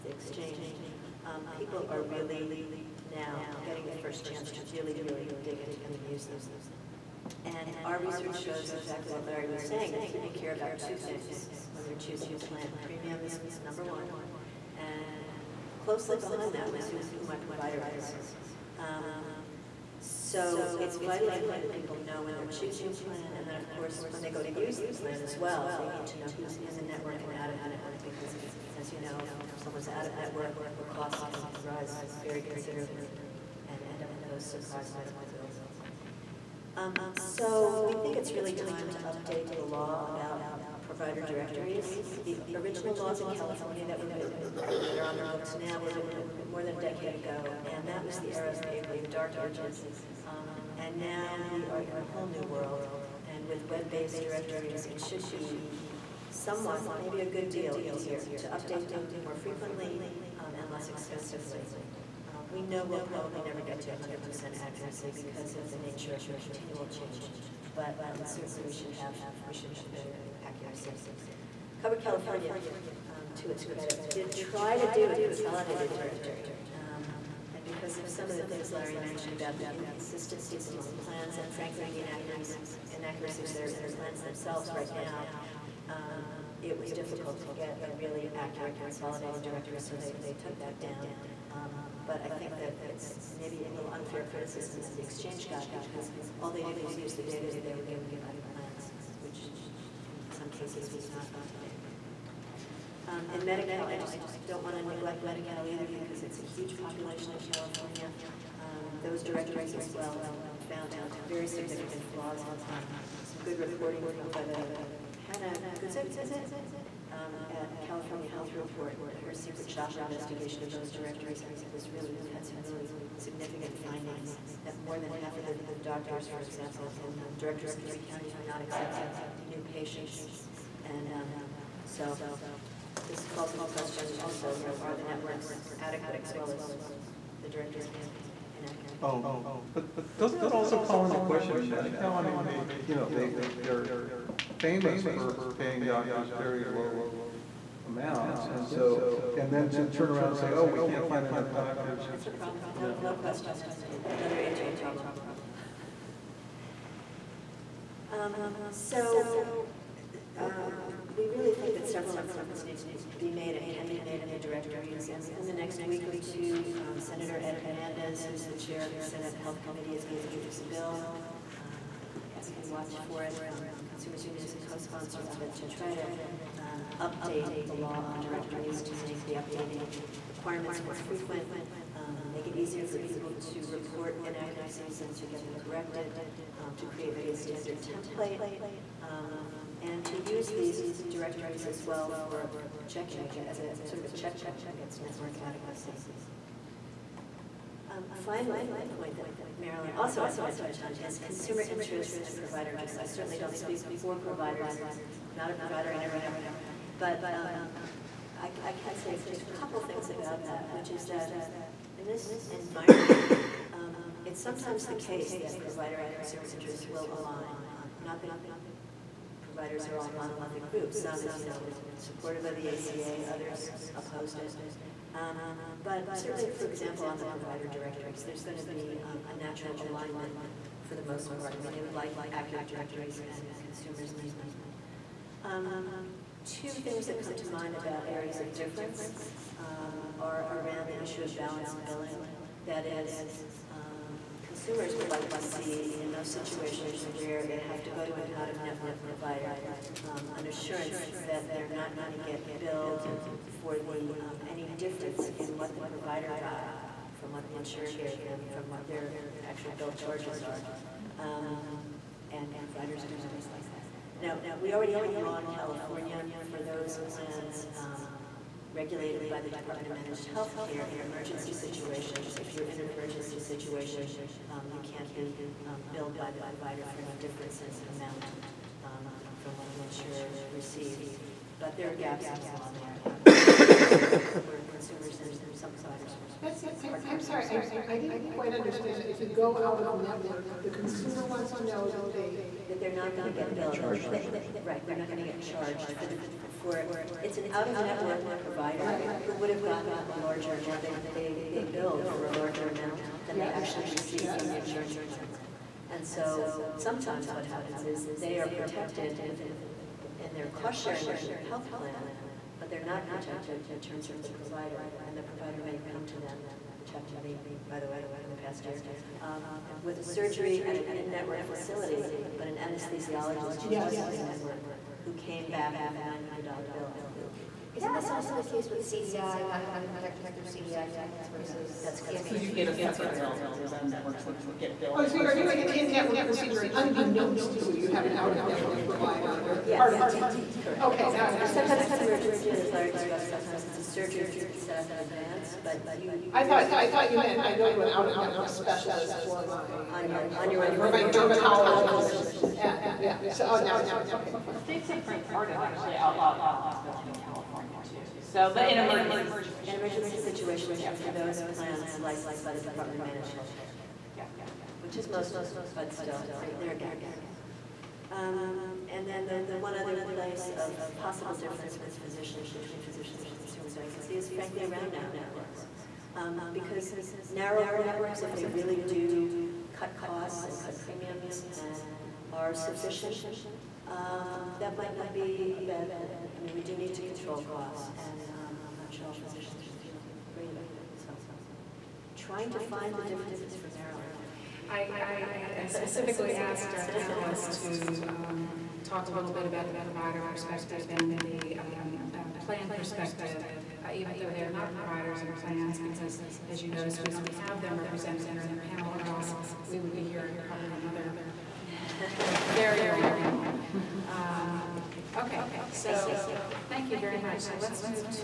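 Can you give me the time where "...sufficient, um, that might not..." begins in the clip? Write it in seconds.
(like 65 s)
382 s.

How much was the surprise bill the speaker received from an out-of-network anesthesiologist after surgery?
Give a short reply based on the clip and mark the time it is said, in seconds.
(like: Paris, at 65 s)
$900, at 326 s.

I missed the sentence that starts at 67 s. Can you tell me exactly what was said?
But um, certainly we should have we should have better accuracy.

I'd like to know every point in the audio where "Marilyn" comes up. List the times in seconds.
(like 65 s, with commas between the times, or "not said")
199 s, 393 s.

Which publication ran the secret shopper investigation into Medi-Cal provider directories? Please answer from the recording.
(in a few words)
California Health Report.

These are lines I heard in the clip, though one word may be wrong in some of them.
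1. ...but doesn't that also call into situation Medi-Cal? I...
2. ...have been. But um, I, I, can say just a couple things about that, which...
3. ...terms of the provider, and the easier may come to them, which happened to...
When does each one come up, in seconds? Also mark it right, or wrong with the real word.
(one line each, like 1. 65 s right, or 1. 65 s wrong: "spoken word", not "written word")
1. 139 s wrong: "question", not "situation"
2. 206 s right
3. 313 s wrong: "provider", not "easier".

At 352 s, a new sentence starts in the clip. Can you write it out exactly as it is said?
And, yeah, so, oh, now I see, okay, fine.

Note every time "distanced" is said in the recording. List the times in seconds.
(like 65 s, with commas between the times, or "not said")
not said.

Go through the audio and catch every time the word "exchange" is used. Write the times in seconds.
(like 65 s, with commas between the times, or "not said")
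0 s, 95 s.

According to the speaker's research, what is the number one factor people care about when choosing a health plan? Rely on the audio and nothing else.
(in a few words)
Premium.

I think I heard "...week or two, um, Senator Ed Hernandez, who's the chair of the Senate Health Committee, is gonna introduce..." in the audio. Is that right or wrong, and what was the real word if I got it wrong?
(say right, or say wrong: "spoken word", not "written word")
right.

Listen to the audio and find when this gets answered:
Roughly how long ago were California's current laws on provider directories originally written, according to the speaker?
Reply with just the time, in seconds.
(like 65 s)
46 s.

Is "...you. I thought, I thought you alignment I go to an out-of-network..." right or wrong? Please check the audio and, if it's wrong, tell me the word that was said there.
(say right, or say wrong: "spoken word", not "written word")
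wrong: "meant", not "alignment".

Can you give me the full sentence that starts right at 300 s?
They they they billed for a larger amount than yes.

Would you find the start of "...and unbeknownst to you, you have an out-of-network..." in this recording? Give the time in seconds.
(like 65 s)
336 s.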